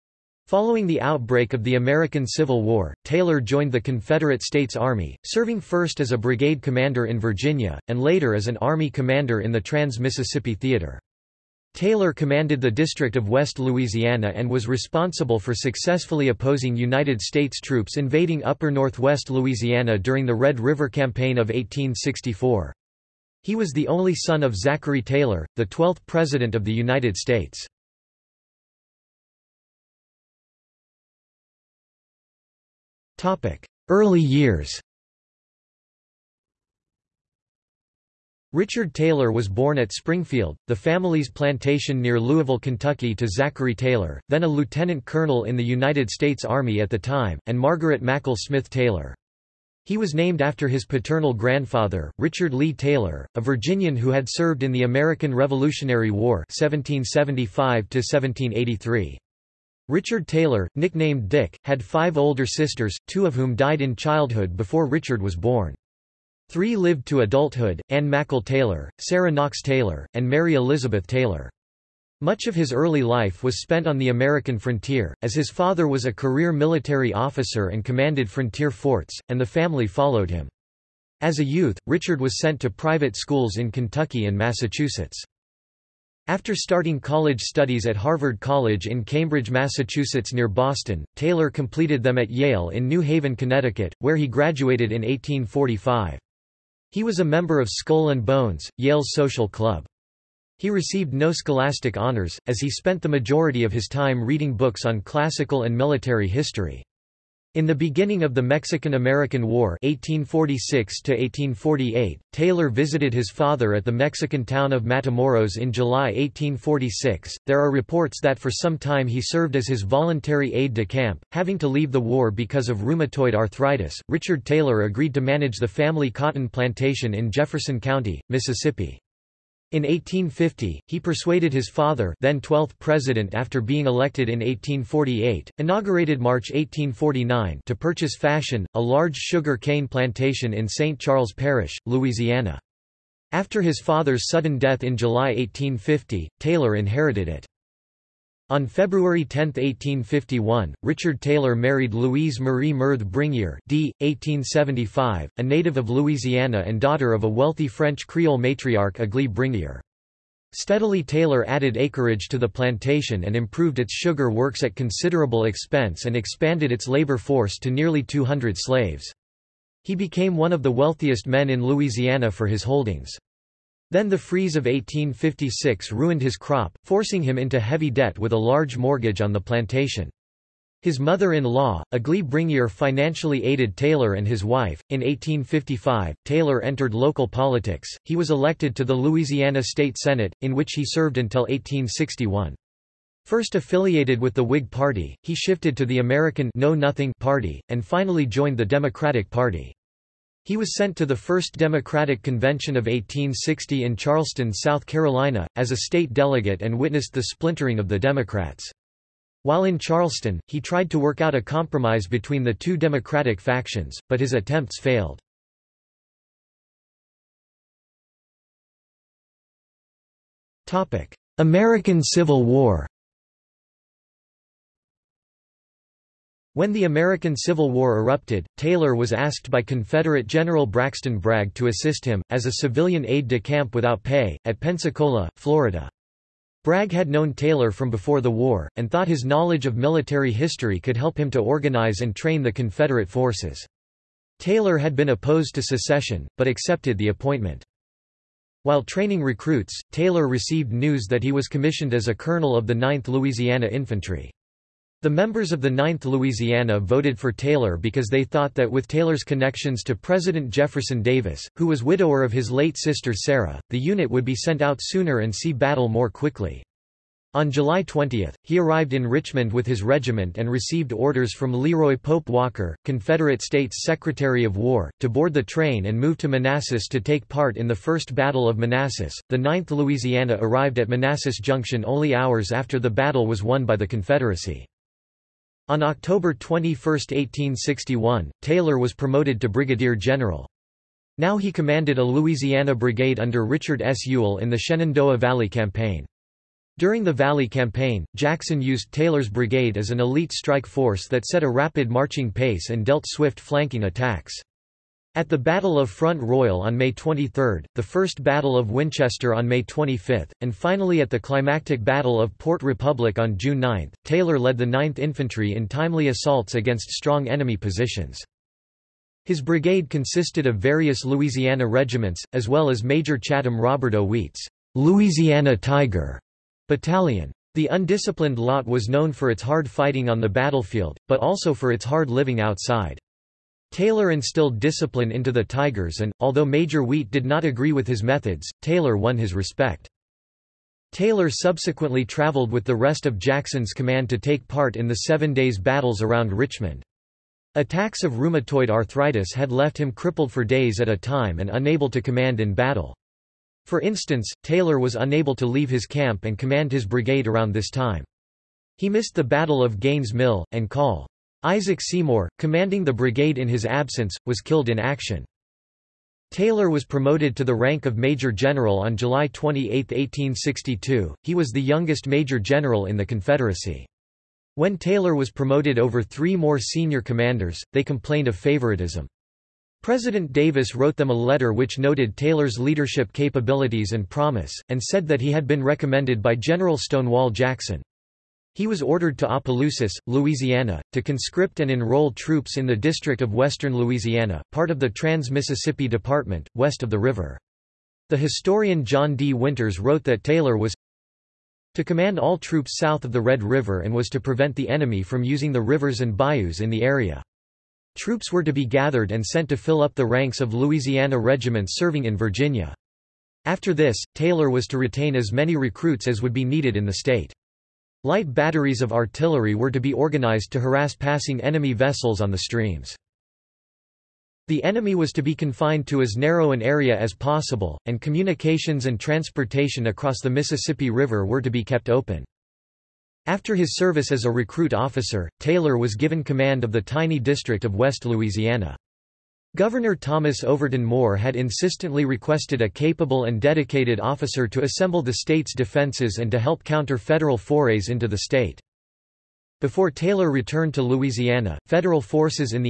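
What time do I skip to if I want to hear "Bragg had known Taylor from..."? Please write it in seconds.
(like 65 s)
236 s.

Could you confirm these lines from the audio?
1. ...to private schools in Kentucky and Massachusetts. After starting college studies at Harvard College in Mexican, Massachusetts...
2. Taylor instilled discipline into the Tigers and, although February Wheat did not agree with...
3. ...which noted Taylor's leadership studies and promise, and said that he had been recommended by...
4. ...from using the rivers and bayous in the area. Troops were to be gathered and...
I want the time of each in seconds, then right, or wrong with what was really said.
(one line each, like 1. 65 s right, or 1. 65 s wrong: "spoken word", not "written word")
1. 82 s wrong: "Cambridge", not "Mexican"
2. 333 s wrong: "Major", not "February"
3. 381 s wrong: "capabilities", not "studies"
4. 405 s right.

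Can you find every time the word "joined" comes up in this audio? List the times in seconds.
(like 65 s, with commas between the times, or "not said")
3 s, 198 s.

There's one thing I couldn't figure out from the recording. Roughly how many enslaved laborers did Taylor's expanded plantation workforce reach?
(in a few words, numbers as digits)
nearly 200.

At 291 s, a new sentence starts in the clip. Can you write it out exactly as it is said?
Now he commanded a Louisiana brigade under Richard S.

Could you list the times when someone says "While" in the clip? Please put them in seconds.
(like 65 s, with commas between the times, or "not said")
209 s, 248 s.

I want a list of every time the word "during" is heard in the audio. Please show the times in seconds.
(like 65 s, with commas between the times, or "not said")
19 s, 296 s.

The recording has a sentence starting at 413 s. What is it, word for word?
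After this, Taylor was to retain as many recruits as would be needed in the state.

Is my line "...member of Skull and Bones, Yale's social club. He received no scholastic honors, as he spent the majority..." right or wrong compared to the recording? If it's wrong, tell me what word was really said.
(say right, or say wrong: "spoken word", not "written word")
right.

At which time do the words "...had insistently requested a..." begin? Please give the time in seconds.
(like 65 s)
441 s.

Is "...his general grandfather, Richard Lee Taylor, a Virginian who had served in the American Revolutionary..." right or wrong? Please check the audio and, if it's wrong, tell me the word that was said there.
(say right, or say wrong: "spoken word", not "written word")
wrong: "paternal", not "general".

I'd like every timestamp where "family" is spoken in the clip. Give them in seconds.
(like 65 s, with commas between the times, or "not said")
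40 s, 79 s, 125 s.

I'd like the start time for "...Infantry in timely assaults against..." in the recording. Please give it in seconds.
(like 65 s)
314 s.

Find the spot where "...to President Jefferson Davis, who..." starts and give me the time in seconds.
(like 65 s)
259 s.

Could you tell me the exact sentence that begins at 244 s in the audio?
Taylor had been opposed to secession, but accepted the appointment.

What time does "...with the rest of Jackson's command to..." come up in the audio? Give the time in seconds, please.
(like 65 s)
342 s.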